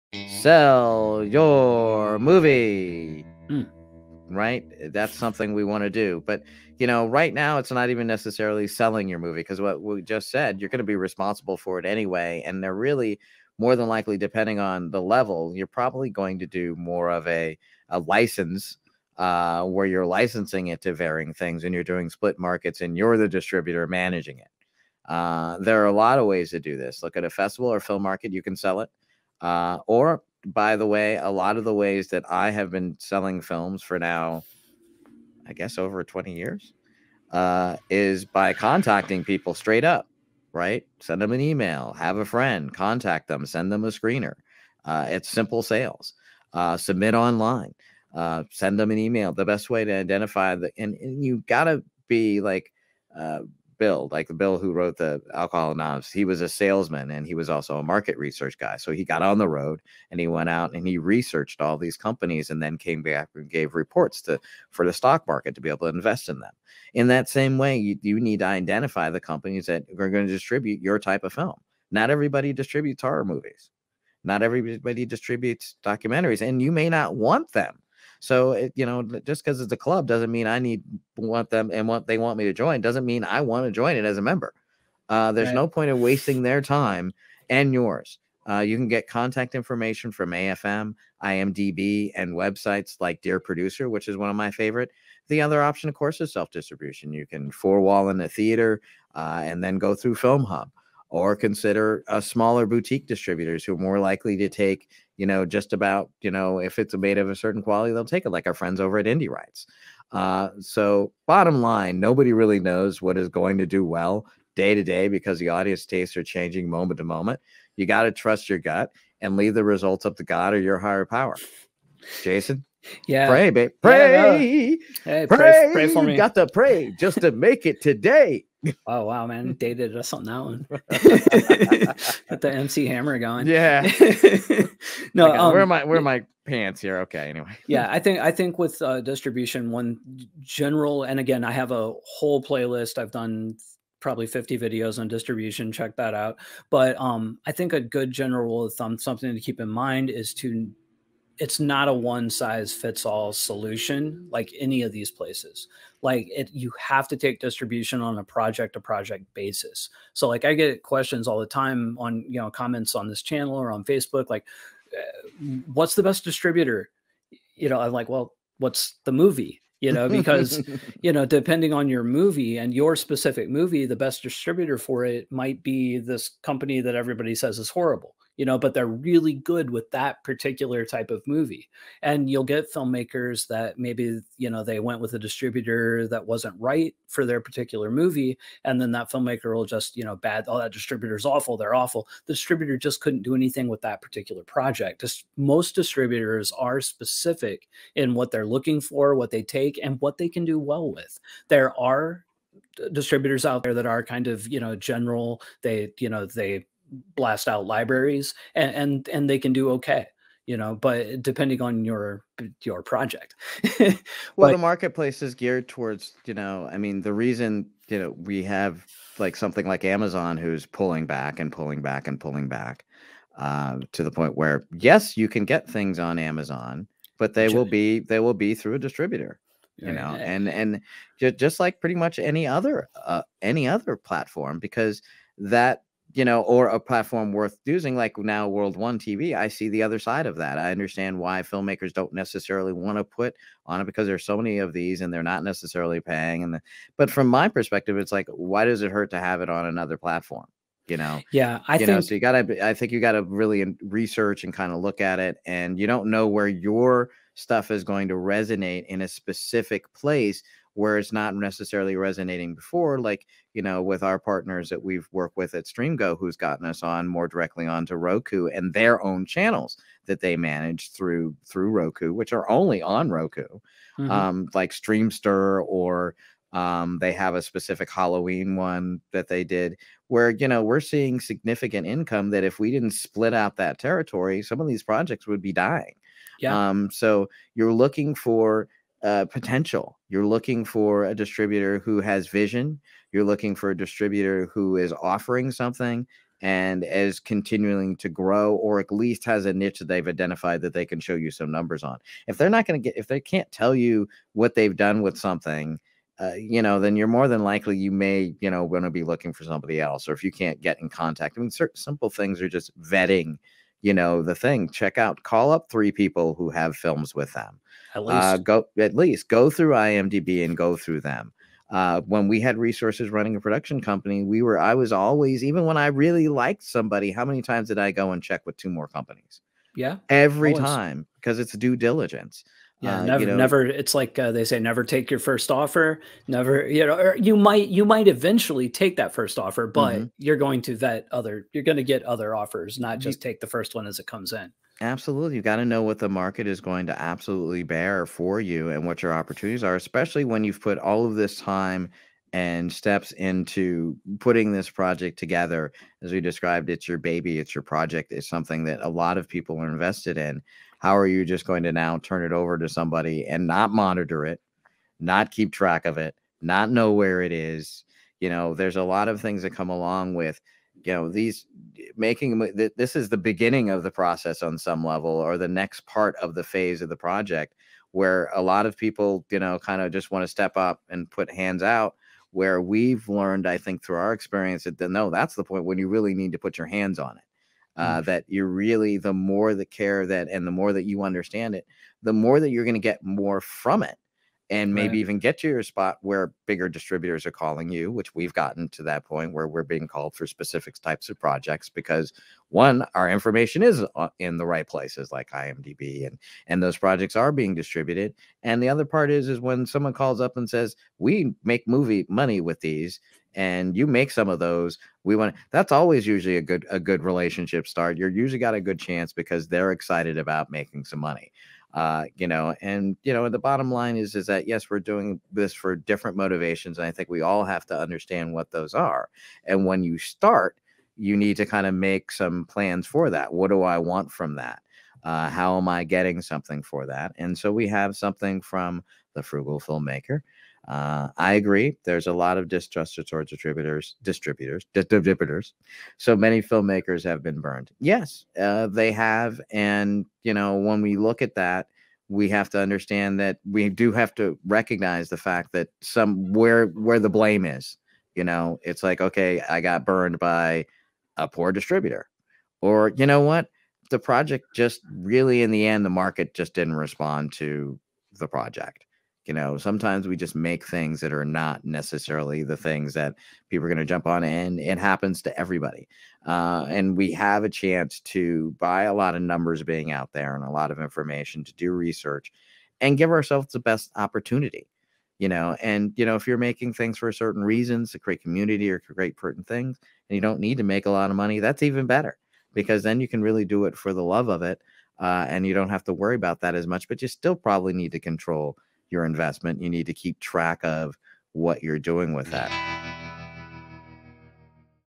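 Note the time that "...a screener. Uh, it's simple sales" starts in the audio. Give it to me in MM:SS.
00:43.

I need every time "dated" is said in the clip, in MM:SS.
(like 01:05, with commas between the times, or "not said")
02:09.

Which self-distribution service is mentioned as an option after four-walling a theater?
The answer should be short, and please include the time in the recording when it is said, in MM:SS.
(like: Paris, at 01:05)
Filmhub, at 01:40.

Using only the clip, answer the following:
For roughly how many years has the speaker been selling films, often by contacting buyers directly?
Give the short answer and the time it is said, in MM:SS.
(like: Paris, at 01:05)
over 20 years, at 00:35.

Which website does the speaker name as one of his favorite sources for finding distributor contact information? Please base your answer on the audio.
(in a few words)
Dear Producer.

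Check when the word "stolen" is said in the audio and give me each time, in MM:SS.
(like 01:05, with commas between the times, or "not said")
not said.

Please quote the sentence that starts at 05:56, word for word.
As we described, it's your baby, it's your project, it's something that a lot of people are invested in.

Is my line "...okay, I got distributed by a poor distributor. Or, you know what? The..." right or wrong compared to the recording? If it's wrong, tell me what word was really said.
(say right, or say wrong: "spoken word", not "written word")
wrong: "burned", not "distributed".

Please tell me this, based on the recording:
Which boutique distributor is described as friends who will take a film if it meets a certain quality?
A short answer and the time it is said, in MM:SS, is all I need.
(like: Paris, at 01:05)
Indie Rights, at 01:49.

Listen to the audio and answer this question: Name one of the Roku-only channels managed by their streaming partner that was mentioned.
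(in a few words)
Streamster.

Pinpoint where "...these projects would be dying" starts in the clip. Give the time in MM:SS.
04:44.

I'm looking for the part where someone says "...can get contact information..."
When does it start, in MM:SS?
01:28.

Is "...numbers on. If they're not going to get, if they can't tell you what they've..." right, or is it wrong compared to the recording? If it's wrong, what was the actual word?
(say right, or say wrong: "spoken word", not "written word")
right.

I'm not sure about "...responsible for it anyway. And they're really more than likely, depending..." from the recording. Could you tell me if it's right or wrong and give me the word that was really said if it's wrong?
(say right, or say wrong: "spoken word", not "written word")
right.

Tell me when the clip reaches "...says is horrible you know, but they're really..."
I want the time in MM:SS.
02:57.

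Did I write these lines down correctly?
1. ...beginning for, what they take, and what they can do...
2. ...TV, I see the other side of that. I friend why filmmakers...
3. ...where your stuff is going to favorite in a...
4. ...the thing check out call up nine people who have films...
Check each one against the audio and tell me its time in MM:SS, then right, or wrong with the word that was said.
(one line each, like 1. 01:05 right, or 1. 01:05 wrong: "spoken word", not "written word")
1. 03:18 wrong: "looking", not "beginning"
2. 03:58 wrong: "understand", not "friend"
3. 04:16 wrong: "resonate", not "favorite"
4. 05:14 wrong: "three", not "nine".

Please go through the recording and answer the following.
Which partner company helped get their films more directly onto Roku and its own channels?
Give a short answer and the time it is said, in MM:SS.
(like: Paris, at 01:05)
StreamGo, at 04:25.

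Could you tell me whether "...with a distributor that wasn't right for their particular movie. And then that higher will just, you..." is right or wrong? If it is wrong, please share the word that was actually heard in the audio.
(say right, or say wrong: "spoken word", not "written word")
wrong: "filmmaker", not "higher".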